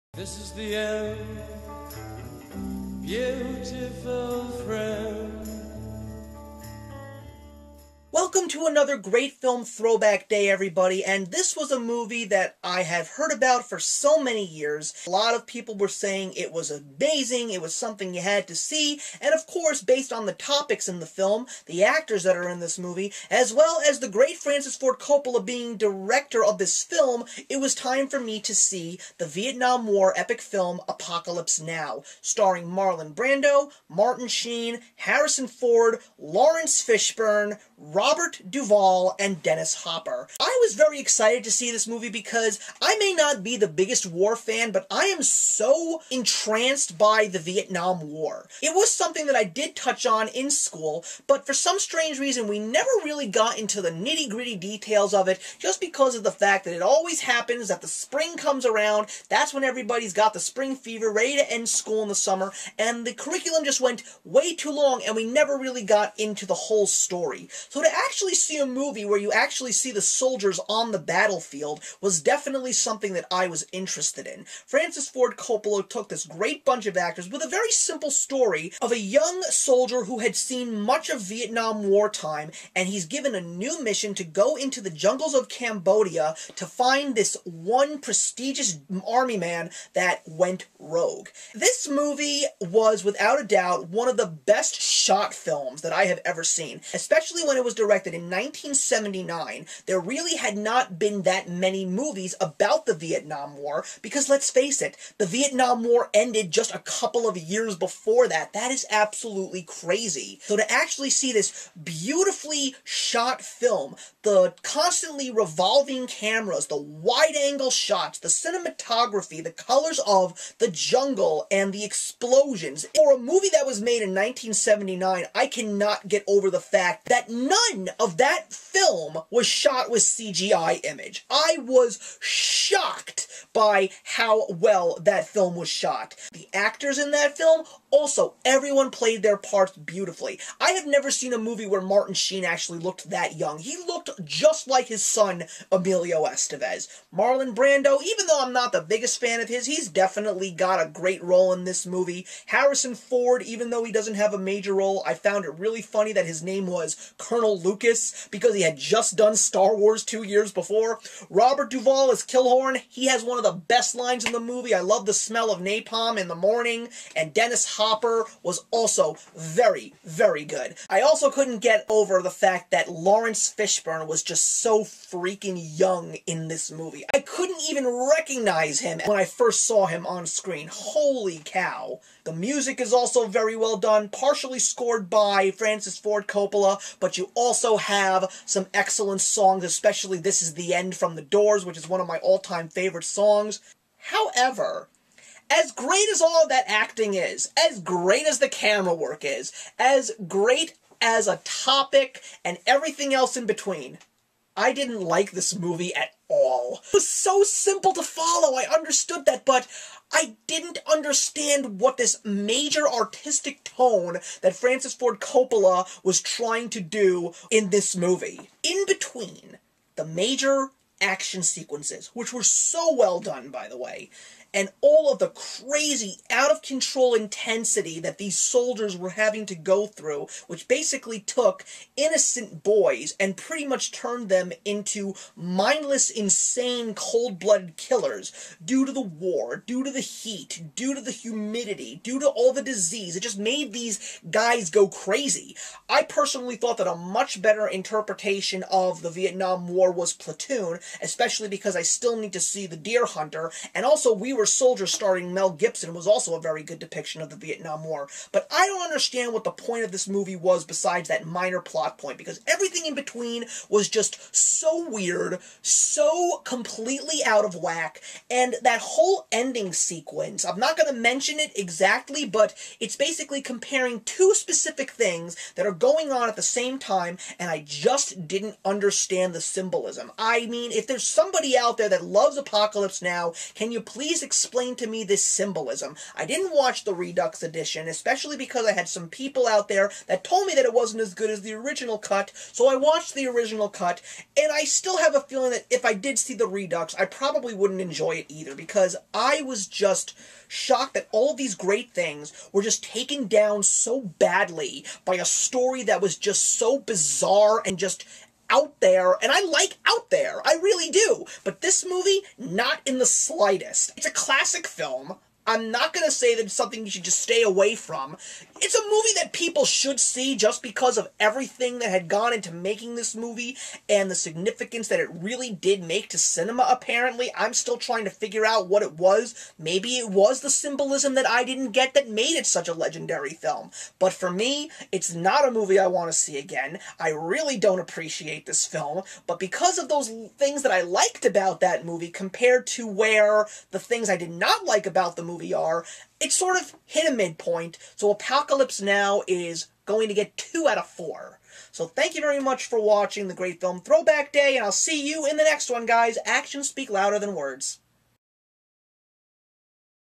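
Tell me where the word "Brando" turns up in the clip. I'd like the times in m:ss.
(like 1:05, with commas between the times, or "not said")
0:33, 2:27.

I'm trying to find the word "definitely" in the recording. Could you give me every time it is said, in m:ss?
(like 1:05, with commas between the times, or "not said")
1:12, 2:29.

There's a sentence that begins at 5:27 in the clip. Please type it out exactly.
I'm still trying to figure out what it was.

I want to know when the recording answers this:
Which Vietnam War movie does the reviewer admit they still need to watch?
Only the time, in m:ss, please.
4:12.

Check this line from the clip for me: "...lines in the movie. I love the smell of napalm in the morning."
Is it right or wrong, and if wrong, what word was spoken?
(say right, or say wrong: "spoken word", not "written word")
right.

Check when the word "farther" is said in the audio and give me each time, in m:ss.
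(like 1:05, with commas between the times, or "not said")
not said.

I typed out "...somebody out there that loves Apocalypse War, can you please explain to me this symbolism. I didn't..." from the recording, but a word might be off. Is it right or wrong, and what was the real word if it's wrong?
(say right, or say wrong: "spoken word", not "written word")
wrong: "Now", not "War".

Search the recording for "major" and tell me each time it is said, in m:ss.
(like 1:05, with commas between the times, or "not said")
2:34, 3:32, 3:40.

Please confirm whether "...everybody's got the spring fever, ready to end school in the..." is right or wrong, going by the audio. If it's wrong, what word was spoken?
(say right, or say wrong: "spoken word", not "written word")
right.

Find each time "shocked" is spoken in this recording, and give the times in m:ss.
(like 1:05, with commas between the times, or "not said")
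2:12, 5:00.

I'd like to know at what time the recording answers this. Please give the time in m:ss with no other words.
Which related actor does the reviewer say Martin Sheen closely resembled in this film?
2:25.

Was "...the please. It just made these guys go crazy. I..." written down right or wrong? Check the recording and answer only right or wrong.
wrong.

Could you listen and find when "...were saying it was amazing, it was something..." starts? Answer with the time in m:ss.
0:15.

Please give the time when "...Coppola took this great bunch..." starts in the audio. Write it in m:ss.
1:15.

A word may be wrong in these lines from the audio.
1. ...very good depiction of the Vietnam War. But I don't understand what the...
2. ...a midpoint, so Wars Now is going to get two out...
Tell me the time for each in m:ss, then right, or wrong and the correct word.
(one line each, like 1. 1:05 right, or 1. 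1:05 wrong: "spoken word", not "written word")
1. 4:16 right
2. 5:47 wrong: "Apocalypse", not "Wars".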